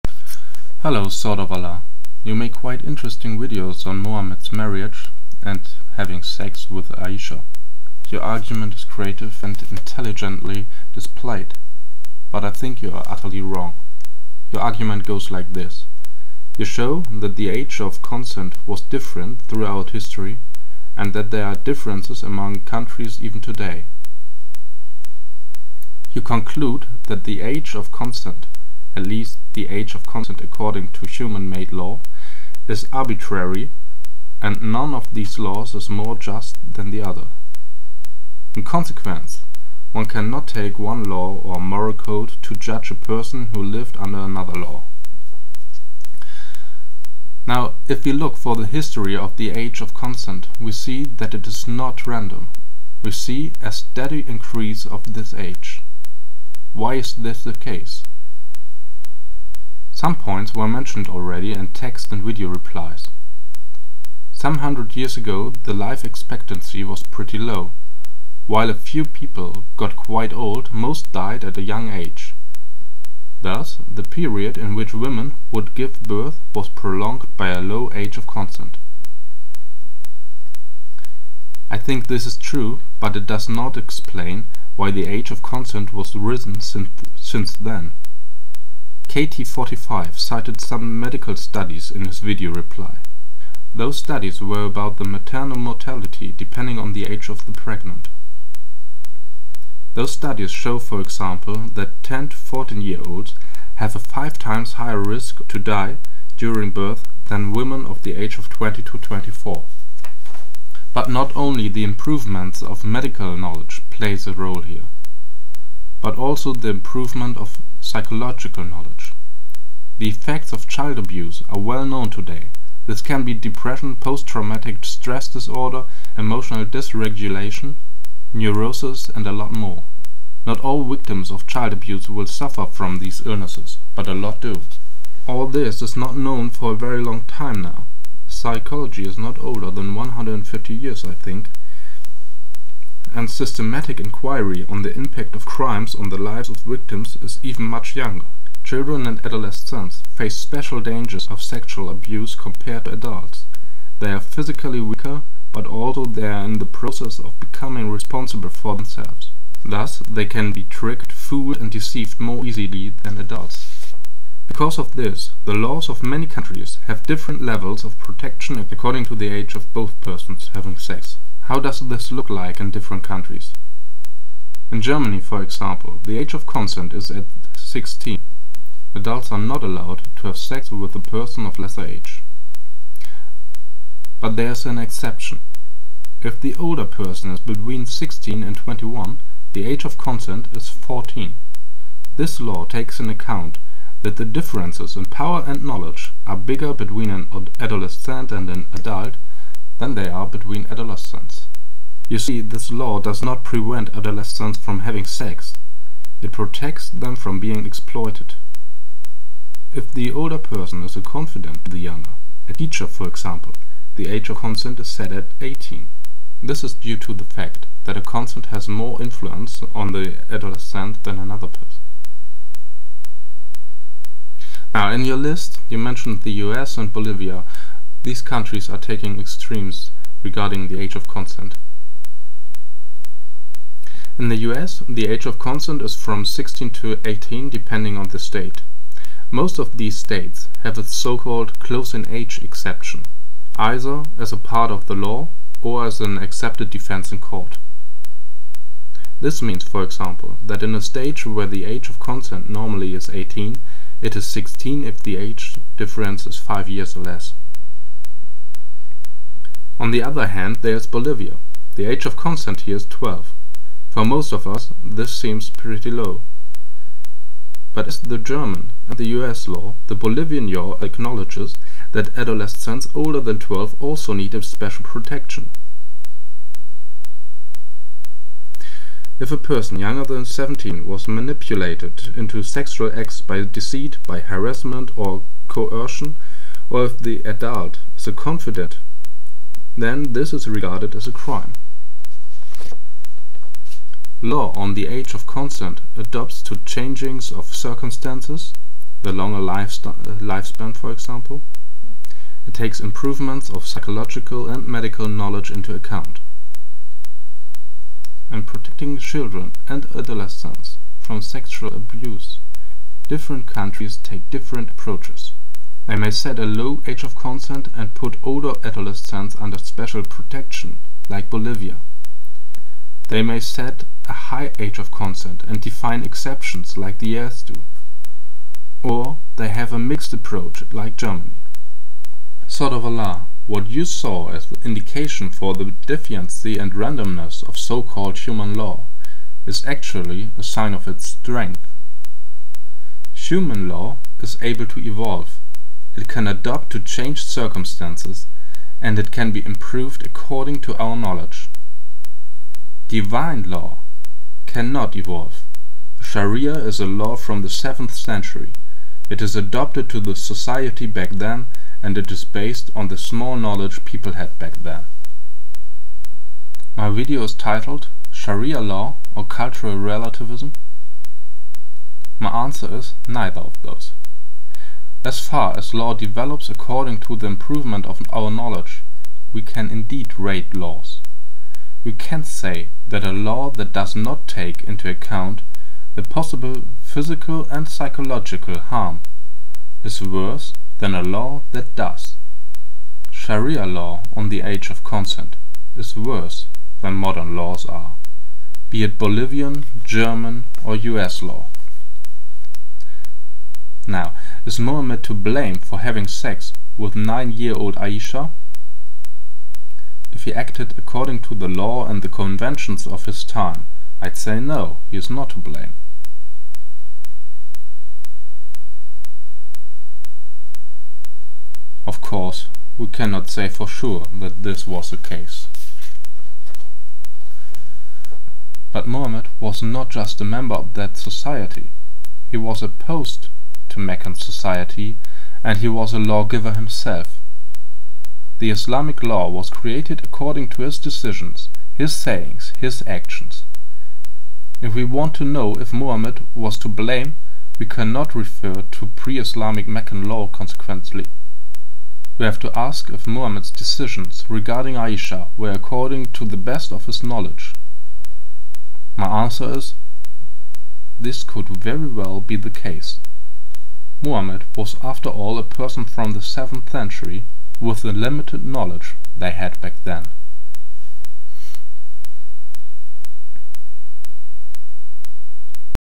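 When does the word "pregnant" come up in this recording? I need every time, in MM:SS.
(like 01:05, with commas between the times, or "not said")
01:37.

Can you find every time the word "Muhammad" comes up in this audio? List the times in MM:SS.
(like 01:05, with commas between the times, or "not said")
07:25, 07:33, 07:44.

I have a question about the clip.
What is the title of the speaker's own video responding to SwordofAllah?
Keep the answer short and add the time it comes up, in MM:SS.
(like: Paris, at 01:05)
Sharia Law or Cultural Relativism?, at 06:08.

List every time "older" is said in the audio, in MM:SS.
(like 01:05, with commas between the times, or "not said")
02:19, 03:06, 03:30, 04:32, 05:18.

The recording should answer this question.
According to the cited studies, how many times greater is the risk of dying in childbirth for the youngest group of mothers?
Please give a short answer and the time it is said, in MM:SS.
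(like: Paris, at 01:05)
5 times, at 01:43.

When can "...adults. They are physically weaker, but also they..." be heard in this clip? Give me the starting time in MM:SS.
02:32.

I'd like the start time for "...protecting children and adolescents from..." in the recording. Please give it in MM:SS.
05:08.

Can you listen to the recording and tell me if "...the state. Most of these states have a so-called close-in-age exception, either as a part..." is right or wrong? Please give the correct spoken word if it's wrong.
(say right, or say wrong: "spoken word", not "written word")
right.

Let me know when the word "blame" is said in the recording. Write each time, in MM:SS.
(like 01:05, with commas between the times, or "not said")
06:45, 06:55, 07:26.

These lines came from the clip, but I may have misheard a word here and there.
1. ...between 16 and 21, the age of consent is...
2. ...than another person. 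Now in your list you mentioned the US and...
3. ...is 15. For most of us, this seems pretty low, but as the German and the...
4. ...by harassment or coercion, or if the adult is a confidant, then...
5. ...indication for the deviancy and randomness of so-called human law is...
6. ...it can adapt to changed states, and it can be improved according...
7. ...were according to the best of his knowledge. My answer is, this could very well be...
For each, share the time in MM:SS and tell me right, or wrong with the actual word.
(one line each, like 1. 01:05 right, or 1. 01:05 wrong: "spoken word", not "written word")
1. 03:07 right
2. 03:41 right
3. 04:22 wrong: "12", not "15"
4. 04:44 right
5. 05:34 right
6. 05:45 wrong: "circumstances", not "states"
7. 07:35 right.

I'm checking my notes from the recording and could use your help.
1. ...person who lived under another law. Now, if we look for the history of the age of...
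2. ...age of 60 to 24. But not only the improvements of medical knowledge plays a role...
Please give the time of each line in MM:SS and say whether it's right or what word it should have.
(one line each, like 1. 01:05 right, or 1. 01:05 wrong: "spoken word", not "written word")
1. 00:42 right
2. 01:48 wrong: "20", not "60".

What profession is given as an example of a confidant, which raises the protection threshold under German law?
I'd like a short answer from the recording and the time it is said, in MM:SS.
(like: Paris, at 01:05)
A teacher, at 03:32.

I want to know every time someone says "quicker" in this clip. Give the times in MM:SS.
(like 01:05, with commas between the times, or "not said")
not said.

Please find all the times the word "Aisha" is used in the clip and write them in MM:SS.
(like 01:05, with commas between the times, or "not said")
00:06, 06:47, 07:34.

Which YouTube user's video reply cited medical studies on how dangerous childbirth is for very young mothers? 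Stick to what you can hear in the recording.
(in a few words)
KT45.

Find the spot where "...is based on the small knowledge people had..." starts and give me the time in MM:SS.
06:02.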